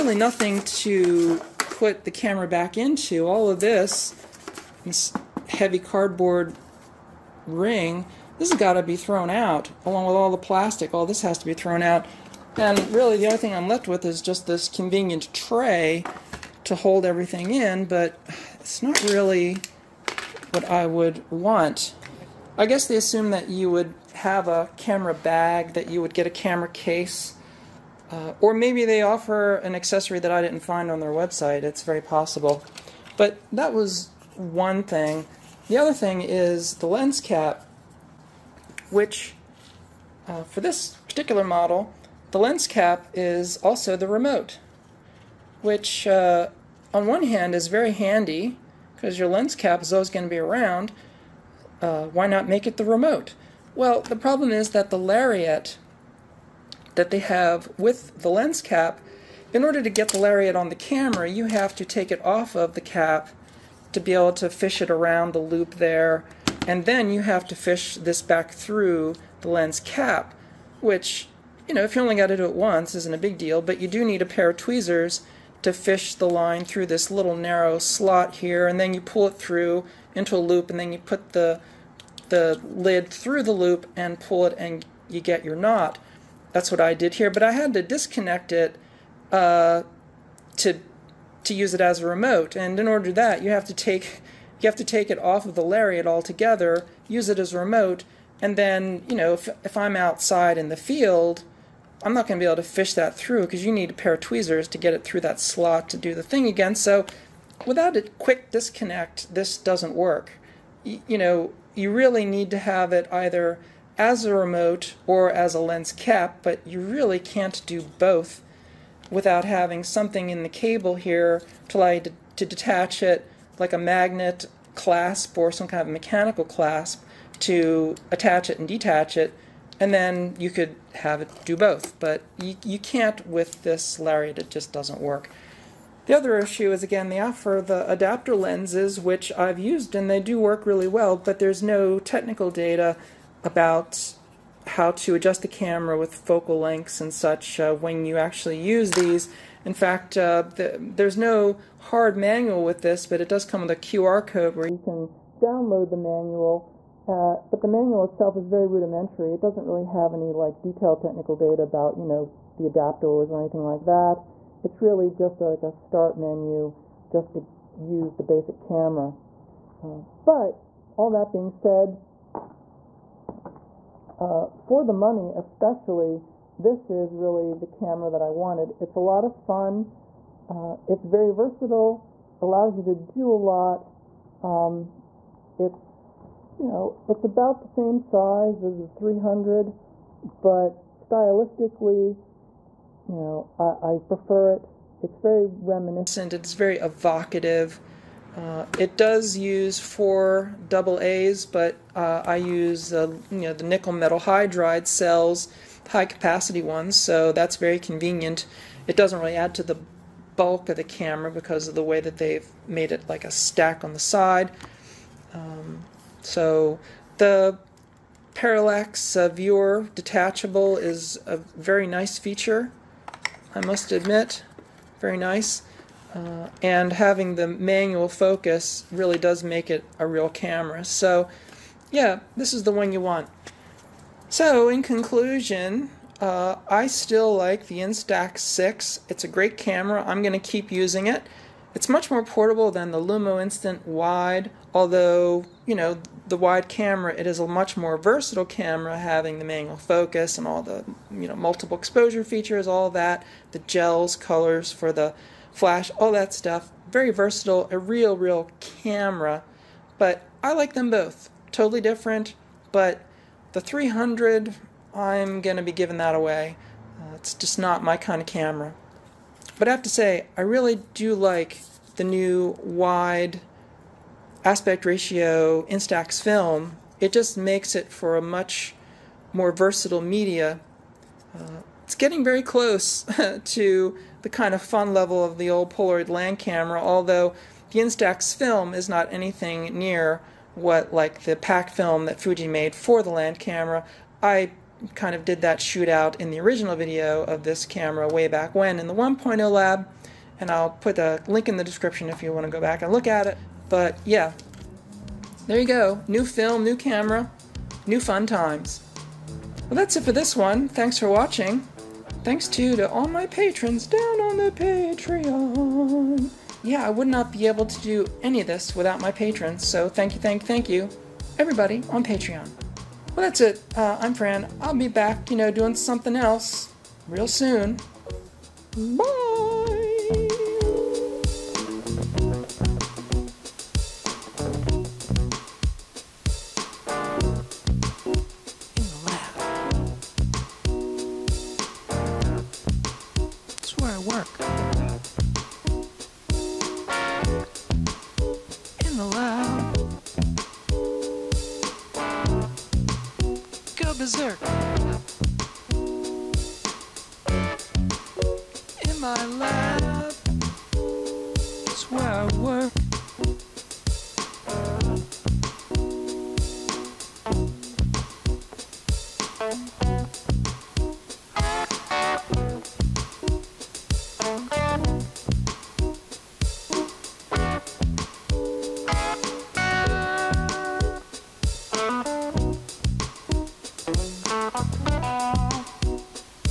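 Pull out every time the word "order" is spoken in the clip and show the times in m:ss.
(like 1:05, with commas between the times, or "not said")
0:59, 1:32.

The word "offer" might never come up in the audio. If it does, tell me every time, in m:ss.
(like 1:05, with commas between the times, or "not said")
0:29, 2:17.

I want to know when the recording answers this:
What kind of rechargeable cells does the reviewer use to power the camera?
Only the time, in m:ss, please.
3:23.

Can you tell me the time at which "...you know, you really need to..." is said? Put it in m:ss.
1:51.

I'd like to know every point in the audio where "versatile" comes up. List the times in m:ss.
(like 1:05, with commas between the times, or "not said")
3:01, 4:07, 4:17, 4:39.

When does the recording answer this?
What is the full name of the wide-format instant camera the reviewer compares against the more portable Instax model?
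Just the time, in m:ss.
4:02.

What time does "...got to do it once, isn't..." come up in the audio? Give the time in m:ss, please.
1:12.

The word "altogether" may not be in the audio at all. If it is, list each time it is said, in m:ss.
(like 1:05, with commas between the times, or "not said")
1:36.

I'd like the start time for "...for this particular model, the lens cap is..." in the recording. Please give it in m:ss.
0:40.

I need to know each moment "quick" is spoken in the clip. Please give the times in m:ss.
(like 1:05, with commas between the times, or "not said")
1:48.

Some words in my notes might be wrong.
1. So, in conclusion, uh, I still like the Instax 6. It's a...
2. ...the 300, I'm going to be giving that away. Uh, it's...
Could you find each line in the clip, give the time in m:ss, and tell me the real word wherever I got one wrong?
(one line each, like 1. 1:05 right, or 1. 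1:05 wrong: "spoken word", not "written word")
1. 3:54 right
2. 4:23 right.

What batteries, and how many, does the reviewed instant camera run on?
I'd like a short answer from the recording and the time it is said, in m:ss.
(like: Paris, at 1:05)
4 AA, at 3:19.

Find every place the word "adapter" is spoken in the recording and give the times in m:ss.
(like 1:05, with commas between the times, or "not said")
2:17, 2:42.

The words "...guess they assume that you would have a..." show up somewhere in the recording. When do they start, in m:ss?
0:22.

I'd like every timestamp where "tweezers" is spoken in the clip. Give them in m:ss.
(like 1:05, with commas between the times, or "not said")
1:14, 1:44.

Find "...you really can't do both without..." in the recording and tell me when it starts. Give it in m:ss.
1:56.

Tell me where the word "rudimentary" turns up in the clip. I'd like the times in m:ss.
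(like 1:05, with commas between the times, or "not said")
2:38.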